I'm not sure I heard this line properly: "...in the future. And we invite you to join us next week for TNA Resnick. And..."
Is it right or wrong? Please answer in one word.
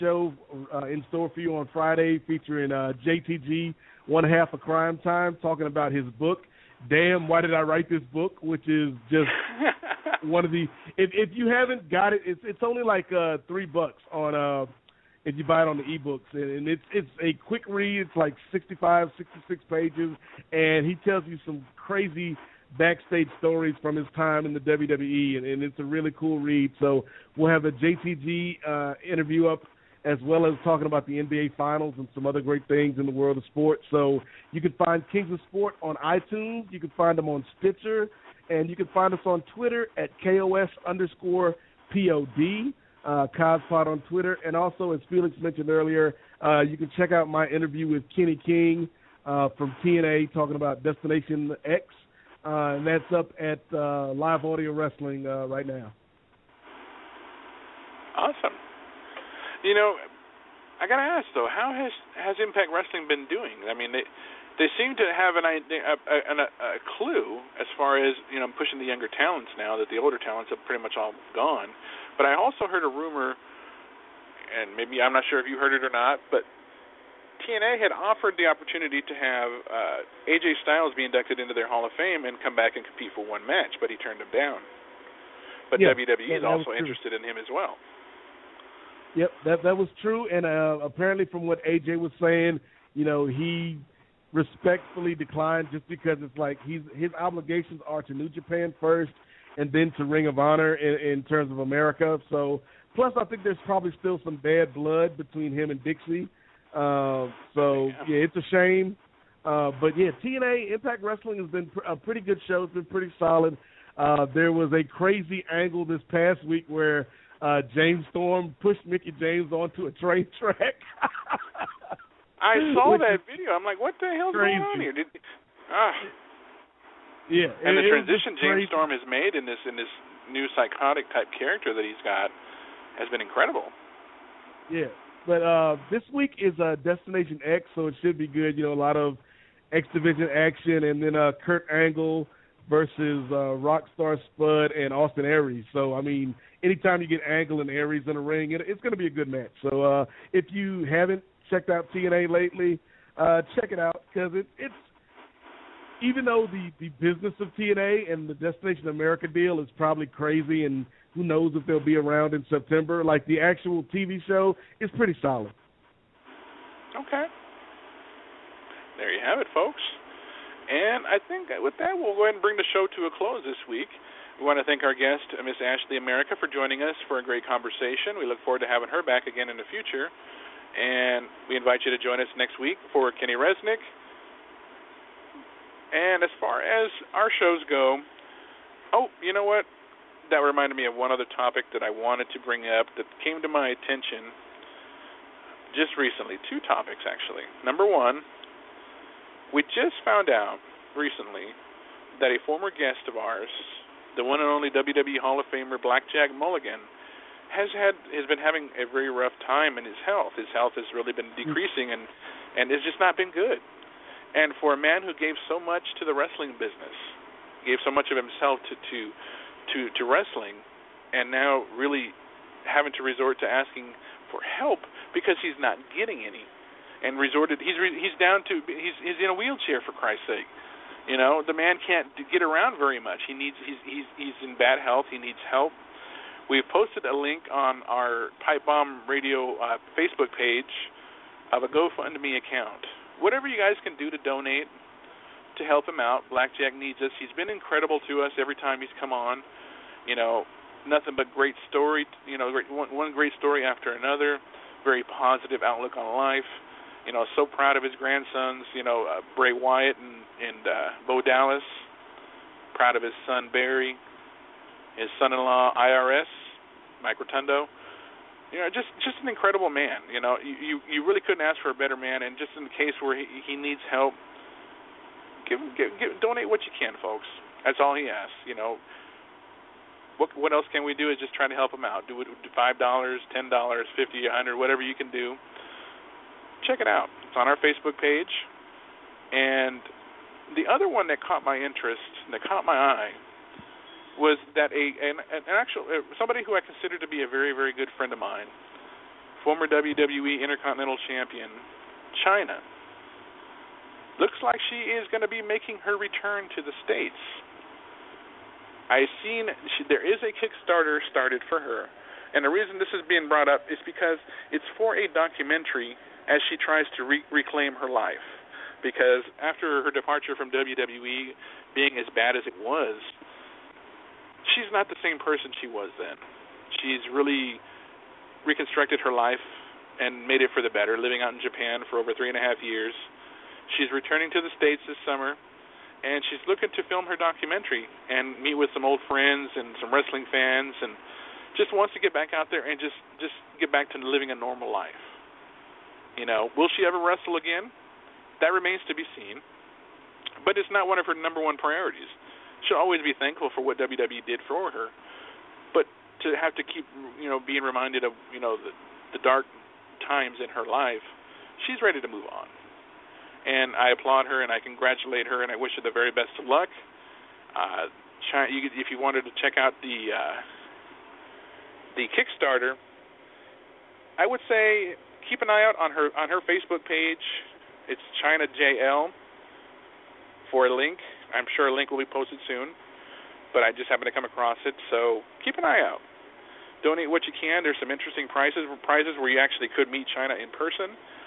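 wrong.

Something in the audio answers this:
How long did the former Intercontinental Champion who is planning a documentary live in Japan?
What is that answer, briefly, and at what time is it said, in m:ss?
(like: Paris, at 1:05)
3 and a half years, at 5:32.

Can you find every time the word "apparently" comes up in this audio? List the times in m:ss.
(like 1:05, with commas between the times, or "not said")
1:30.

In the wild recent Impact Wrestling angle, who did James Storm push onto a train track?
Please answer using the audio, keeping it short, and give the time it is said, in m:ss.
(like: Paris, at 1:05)
Mickie James, at 1:58.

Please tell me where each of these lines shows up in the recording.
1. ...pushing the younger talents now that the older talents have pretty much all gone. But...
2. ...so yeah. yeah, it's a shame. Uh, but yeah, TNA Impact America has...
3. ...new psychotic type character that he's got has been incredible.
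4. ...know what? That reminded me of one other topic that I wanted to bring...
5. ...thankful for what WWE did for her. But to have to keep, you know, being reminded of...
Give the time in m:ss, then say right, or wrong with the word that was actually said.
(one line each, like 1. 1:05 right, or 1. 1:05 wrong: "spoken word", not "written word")
1. 1:08 right
2. 1:47 wrong: "Wrestling", not "America"
3. 2:10 right
4. 3:09 right
5. 5:53 right.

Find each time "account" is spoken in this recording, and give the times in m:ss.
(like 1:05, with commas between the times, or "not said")
4:02.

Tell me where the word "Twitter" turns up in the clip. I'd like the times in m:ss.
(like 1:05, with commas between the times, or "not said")
0:39, 0:44.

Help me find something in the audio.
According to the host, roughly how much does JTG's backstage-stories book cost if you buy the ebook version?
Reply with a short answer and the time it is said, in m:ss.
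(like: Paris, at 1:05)
$3, at 0:13.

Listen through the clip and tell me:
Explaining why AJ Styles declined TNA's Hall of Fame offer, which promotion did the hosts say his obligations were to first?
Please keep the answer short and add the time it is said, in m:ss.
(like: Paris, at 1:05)
New Japan, at 1:38.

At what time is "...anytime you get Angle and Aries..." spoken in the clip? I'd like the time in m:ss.
2:26.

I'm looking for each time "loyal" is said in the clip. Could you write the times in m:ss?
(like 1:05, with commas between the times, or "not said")
not said.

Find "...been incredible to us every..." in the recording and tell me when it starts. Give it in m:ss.
4:07.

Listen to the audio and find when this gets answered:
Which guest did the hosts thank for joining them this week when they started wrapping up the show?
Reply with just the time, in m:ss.
2:55.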